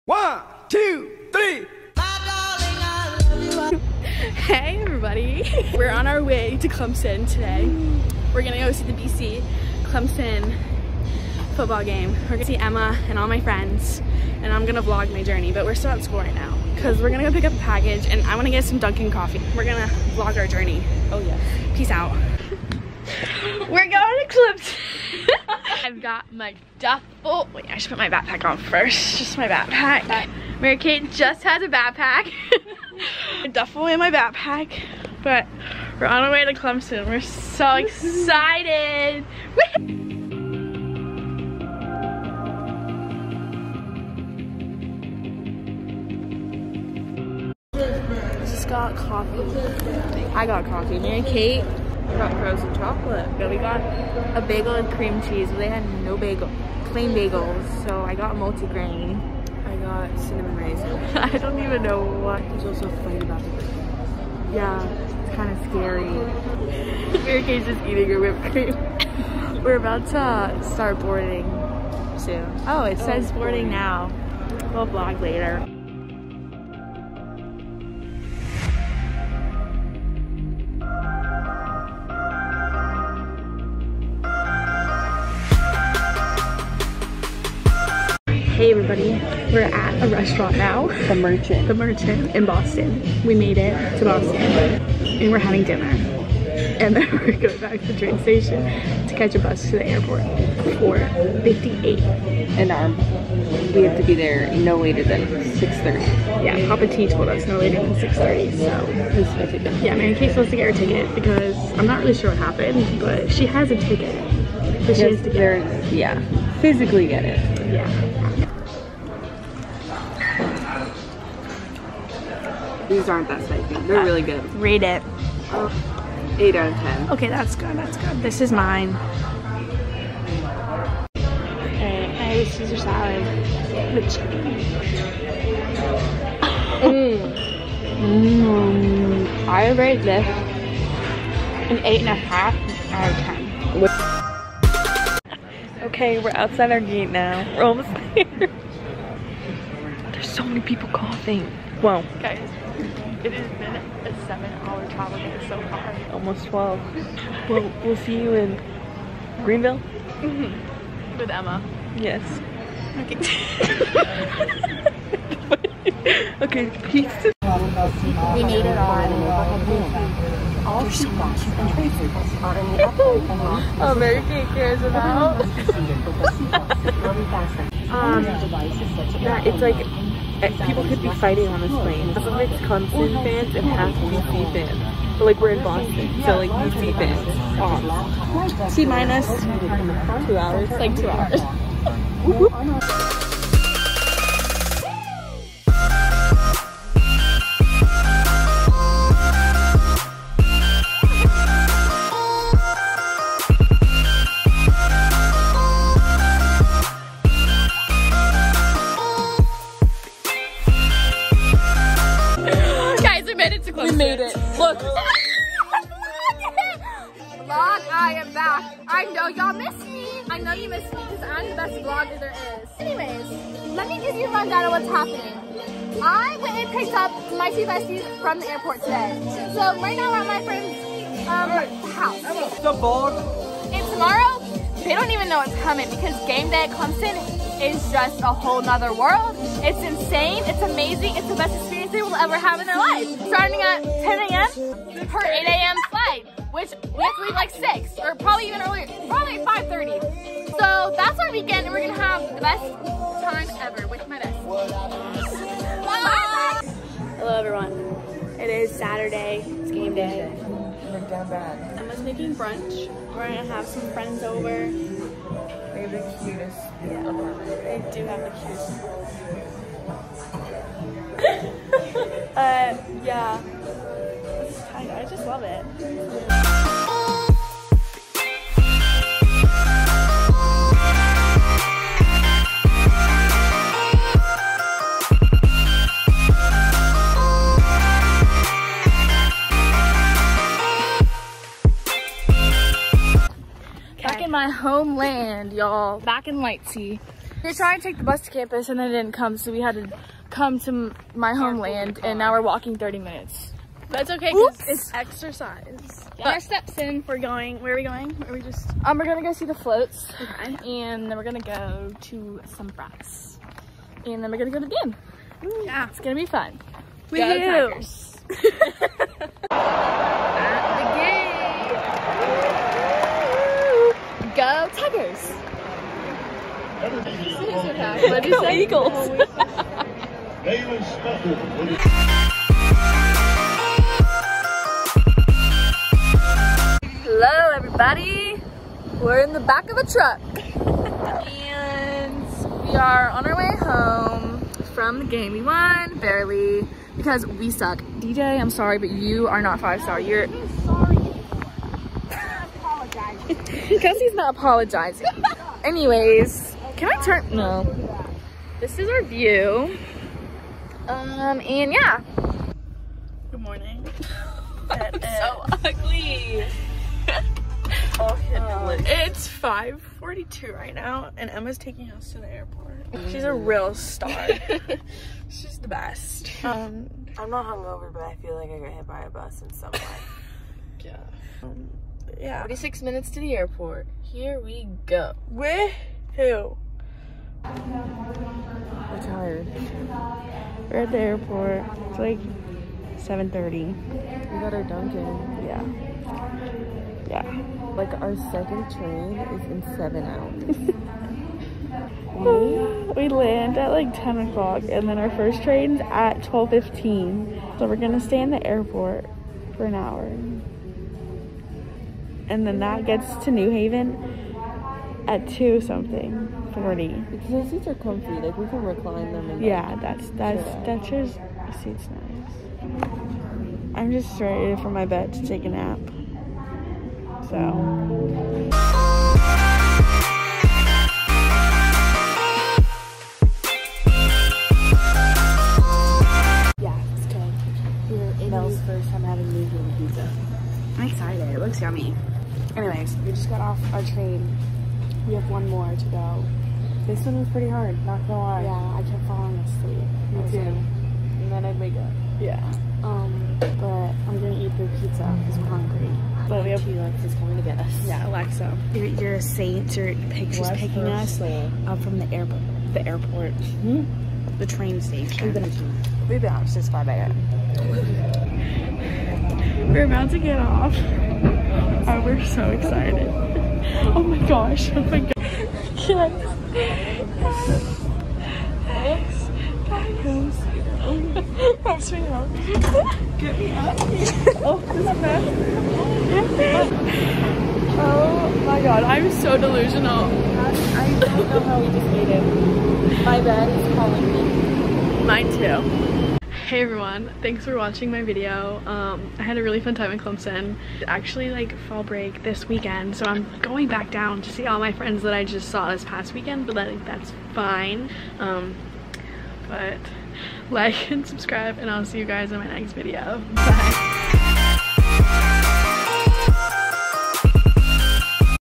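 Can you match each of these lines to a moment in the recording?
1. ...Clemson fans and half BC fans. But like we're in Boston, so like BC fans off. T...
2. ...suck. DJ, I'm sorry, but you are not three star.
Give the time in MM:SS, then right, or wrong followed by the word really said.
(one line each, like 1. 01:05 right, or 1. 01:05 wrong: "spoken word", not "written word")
1. 03:02 right
2. 05:47 wrong: "five", not "three".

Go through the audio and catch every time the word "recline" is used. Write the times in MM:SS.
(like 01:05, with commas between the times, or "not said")
06:58.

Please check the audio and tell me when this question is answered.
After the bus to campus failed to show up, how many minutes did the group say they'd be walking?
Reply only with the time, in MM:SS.
05:02.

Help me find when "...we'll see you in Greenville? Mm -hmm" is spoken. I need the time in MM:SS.
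02:37.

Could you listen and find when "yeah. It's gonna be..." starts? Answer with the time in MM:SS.
05:15.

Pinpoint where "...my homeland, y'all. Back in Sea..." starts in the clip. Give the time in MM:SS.
04:54.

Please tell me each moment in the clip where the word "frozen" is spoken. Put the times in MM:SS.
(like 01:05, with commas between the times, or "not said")
00:52.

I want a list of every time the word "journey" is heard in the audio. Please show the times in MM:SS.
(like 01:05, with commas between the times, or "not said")
00:15, 00:20.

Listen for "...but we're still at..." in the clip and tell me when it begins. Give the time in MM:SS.
00:15.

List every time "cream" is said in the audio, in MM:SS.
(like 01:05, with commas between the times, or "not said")
00:54, 01:08.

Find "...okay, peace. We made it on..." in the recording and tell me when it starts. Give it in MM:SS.
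02:46.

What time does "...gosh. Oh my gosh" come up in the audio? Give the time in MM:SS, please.
07:54.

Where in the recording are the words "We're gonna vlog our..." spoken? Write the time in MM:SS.
00:19.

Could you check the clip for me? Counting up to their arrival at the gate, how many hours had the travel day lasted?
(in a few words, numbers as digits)
7.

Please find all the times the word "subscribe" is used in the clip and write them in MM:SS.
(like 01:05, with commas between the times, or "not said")
08:31.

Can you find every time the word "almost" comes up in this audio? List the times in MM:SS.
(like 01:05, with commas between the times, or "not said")
02:27, 02:36.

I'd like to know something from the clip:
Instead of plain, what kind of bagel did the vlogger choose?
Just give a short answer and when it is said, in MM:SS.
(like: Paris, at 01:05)
Multigrain, at 00:58.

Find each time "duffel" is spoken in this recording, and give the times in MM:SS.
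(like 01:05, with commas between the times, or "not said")
00:26, 00:33.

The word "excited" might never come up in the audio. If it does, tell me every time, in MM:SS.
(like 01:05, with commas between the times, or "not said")
00:37, 07:20, 07:52.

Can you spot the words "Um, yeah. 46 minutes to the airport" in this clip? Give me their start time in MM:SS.
06:21.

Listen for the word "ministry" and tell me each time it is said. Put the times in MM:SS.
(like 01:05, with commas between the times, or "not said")
not said.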